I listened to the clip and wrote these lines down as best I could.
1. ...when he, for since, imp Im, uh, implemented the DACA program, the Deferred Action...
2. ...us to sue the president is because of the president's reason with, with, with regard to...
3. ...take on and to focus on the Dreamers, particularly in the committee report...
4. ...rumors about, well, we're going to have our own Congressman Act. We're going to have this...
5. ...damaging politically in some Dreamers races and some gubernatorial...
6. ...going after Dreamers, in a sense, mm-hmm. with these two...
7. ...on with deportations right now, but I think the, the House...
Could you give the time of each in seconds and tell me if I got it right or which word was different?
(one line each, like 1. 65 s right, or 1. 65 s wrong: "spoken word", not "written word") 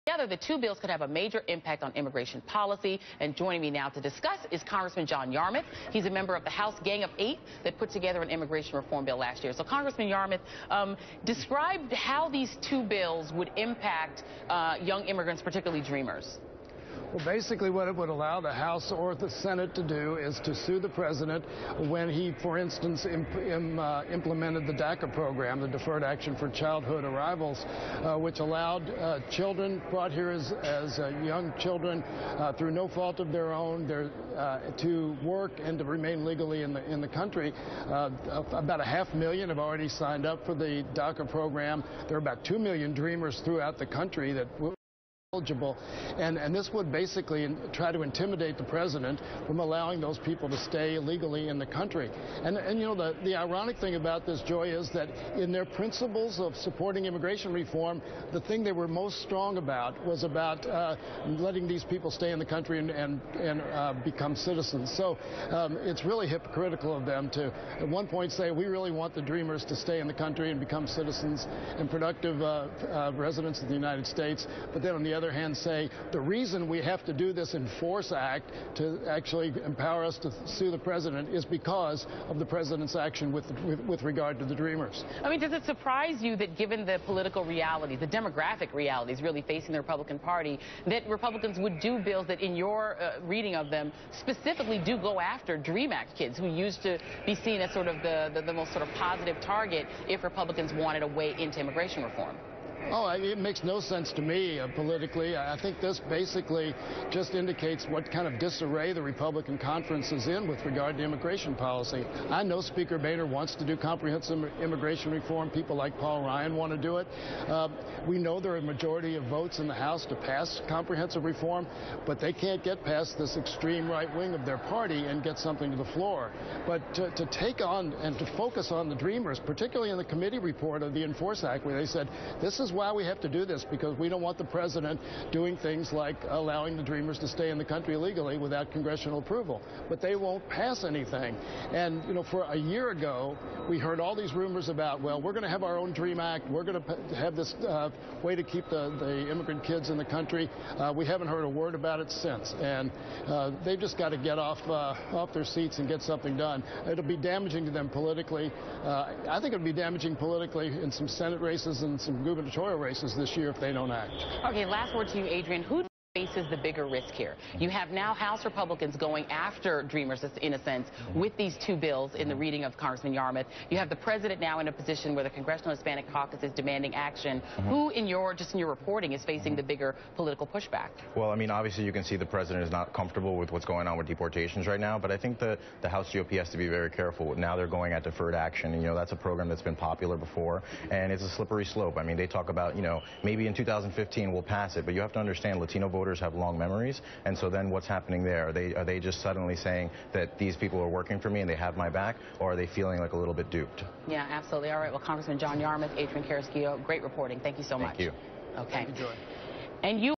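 1. 21 s wrong: "instance", not "since"
2. 80 s wrong: "action", not "reason"
3. 127 s right
4. 144 s wrong: "Dream", not "Congressman"
5. 159 s wrong: "Senate", not "Dreamers"
6. 168 s right
7. 183 s right.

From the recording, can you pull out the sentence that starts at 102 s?
Oh, it makes no sense to me uh, politically.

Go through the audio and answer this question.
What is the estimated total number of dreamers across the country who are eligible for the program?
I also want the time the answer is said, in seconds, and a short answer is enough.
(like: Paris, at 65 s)
2 million, at 42 s.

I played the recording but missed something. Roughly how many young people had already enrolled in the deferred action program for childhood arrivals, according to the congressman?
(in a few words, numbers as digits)
half million.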